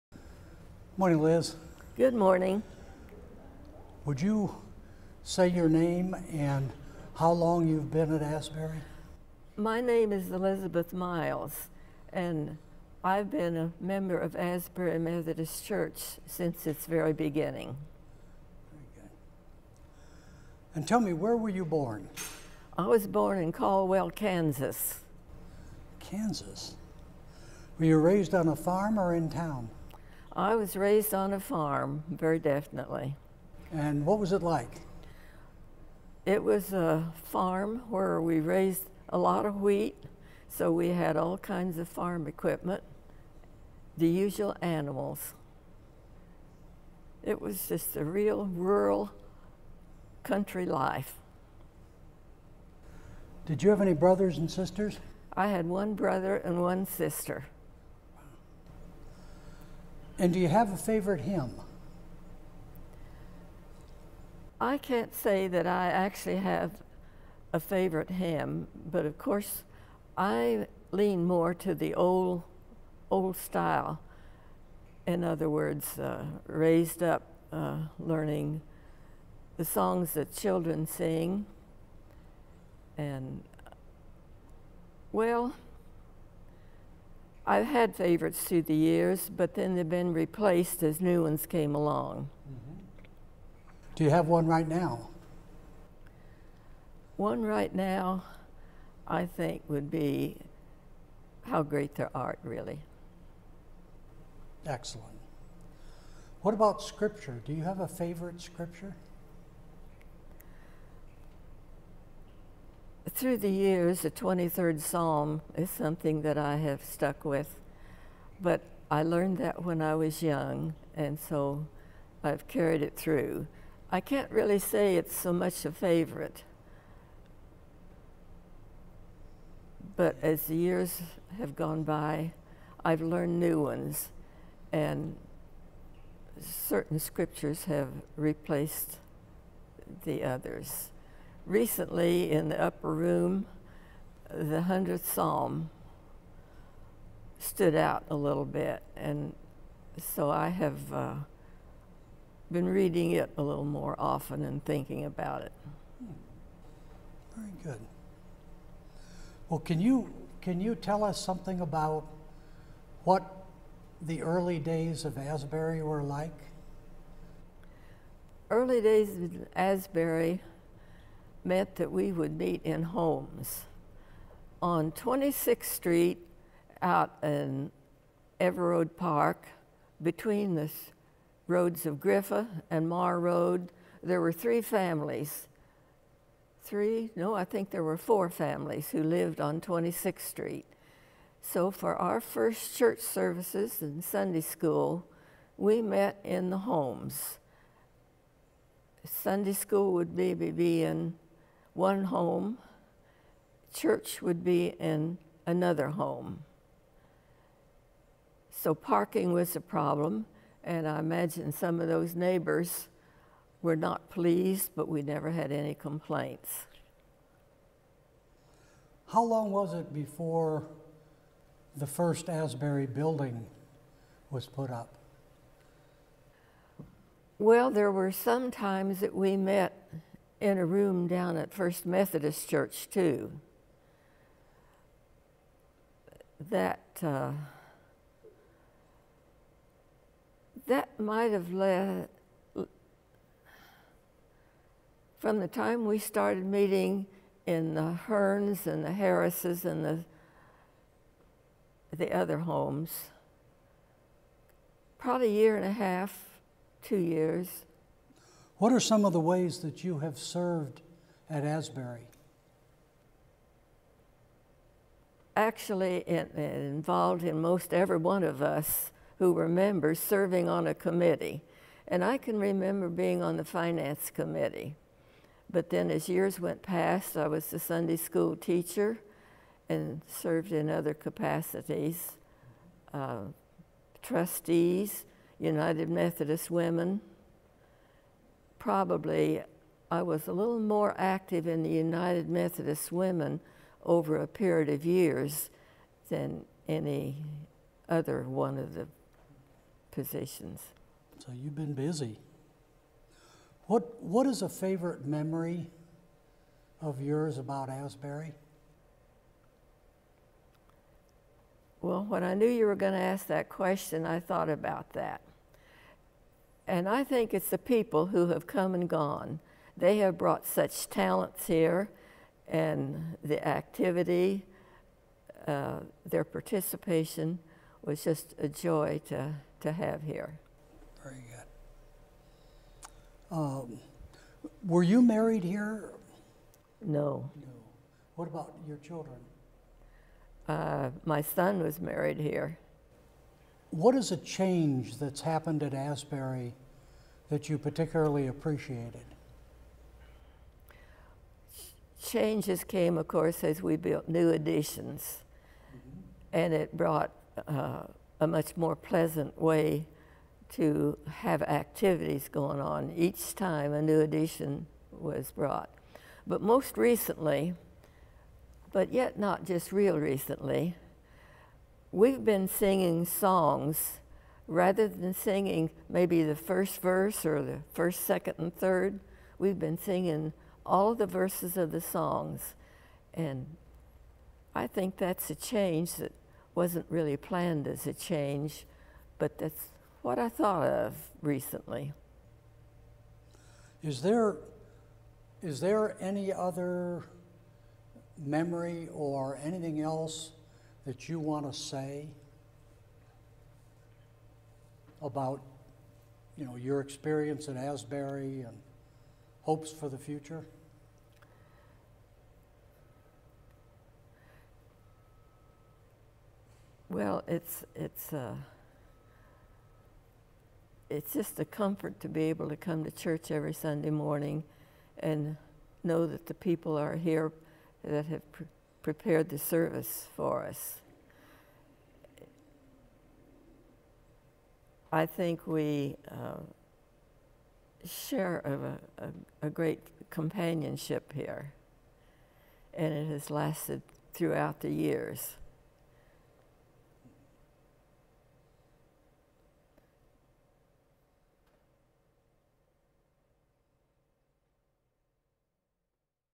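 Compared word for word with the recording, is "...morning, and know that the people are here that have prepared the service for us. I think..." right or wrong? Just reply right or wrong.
right.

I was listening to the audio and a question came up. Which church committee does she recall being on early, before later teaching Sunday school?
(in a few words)
Finance committee.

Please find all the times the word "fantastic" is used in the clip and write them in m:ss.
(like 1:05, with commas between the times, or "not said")
not said.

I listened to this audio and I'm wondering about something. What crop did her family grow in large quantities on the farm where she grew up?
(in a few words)
Wheat.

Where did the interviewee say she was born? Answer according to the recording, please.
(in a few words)
Caldwell, Kansas.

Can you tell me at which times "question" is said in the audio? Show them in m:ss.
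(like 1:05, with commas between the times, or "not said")
5:13.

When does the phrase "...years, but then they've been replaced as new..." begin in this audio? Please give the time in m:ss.
1:28.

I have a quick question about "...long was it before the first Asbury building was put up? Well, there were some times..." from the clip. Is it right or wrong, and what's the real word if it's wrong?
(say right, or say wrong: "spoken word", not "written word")
right.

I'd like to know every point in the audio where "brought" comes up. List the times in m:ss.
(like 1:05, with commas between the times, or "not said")
5:20, 5:56, 6:05.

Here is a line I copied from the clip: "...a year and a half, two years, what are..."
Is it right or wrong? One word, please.
right.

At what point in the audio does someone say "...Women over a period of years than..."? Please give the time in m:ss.
4:52.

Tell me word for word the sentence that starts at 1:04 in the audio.
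I can't say that I actually have a favorite hymn, but of course, I lean more to the old, old style.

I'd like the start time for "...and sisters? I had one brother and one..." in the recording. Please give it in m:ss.
0:54.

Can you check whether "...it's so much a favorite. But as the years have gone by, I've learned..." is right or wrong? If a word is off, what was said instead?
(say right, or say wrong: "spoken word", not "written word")
right.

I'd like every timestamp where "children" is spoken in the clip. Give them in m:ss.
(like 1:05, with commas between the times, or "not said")
1:20, 5:38.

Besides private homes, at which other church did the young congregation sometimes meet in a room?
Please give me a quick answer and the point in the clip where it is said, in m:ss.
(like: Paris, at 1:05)
First Methodist Church, at 3:51.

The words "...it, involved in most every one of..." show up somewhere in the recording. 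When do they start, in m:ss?
4:26.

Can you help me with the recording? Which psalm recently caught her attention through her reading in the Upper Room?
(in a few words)
100th Psalm.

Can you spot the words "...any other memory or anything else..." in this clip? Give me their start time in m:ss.
6:36.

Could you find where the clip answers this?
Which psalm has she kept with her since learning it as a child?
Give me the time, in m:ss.
1:54.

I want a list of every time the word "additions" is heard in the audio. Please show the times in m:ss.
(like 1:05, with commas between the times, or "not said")
5:54, 6:04.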